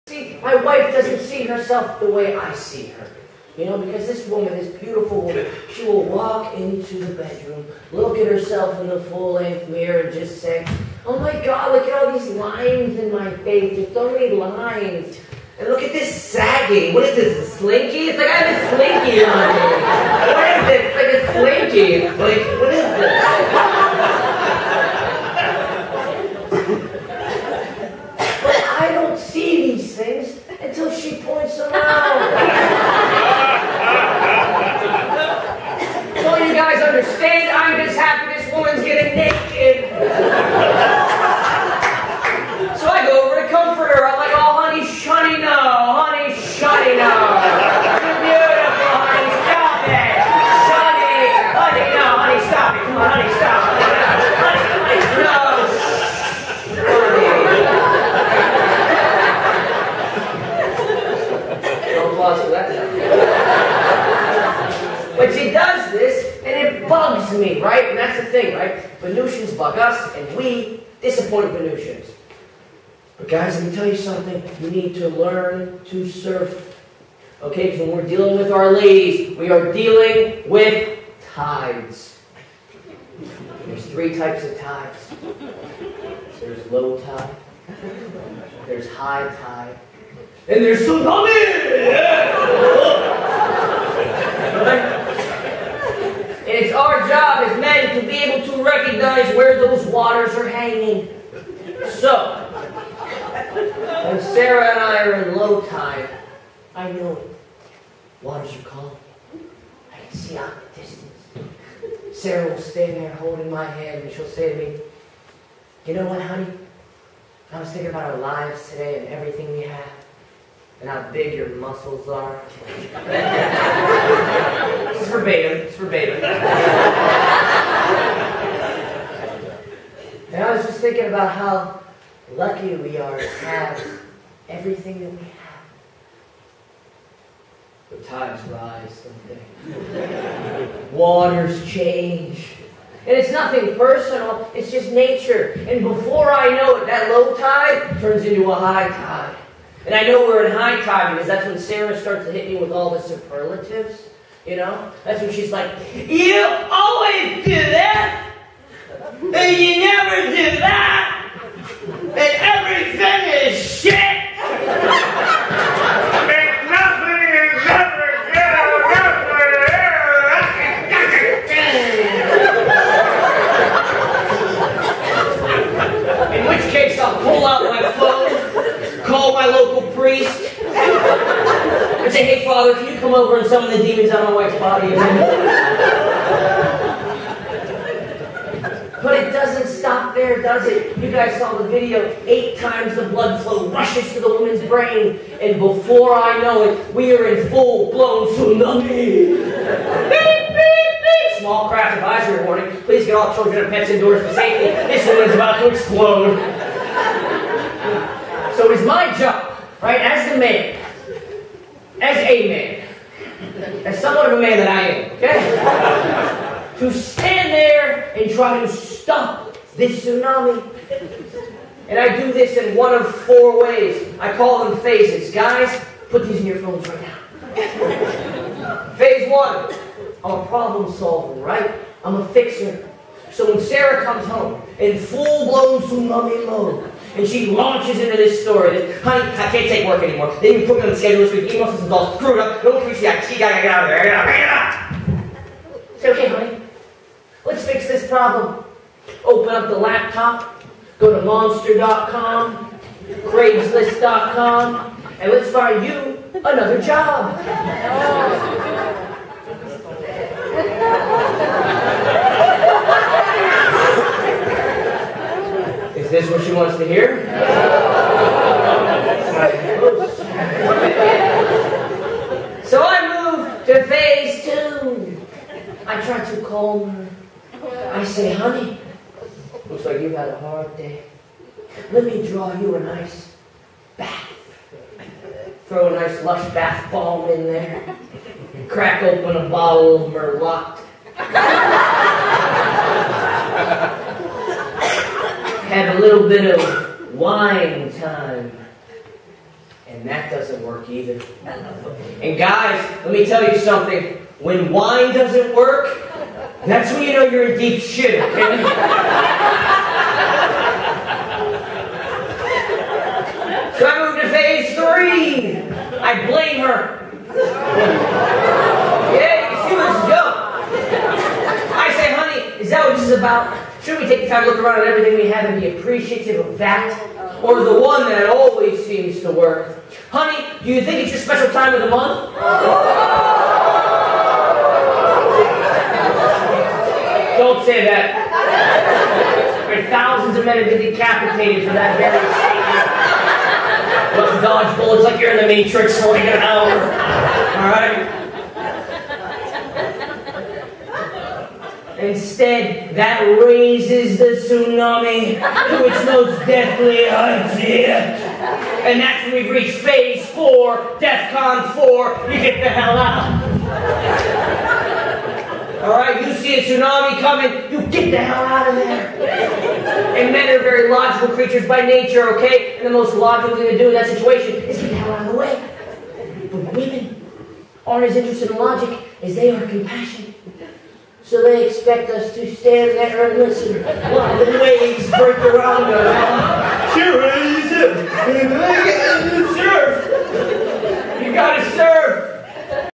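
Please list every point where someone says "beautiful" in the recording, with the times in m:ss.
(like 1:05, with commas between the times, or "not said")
0:04.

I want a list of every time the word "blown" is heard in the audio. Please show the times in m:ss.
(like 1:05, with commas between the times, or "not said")
3:17, 3:55.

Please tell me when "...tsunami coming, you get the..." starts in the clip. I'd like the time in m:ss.
6:06.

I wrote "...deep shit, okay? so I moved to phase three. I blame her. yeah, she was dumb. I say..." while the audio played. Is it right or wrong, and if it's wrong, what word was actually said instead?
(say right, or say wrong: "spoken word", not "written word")
right.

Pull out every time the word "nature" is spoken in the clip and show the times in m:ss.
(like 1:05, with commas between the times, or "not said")
2:24, 6:11.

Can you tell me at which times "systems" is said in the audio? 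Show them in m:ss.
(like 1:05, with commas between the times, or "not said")
4:01.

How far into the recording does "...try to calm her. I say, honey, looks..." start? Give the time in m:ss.
4:36.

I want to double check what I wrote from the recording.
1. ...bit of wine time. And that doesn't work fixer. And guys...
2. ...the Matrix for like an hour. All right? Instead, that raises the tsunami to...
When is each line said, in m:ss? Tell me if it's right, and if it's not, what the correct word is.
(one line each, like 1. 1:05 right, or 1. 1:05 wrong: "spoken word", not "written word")
1. 4:56 wrong: "either", not "fixer"
2. 5:45 right.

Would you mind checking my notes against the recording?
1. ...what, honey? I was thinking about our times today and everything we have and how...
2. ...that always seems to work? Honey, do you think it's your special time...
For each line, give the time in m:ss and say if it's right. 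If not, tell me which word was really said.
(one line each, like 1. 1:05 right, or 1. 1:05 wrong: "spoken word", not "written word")
1. 1:56 wrong: "lives", not "times"
2. 5:28 right.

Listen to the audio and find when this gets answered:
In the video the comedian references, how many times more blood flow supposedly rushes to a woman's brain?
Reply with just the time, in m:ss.
3:12.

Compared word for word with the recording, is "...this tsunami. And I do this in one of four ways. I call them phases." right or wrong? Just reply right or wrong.
right.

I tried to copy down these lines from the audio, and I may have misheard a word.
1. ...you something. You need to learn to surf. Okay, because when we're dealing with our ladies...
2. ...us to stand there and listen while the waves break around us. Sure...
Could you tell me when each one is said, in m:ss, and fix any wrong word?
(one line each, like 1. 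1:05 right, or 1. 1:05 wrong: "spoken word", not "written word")
1. 1:13 right
2. 6:22 right.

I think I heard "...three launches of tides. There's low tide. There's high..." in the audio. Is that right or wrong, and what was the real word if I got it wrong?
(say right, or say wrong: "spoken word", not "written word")
wrong: "types", not "launches".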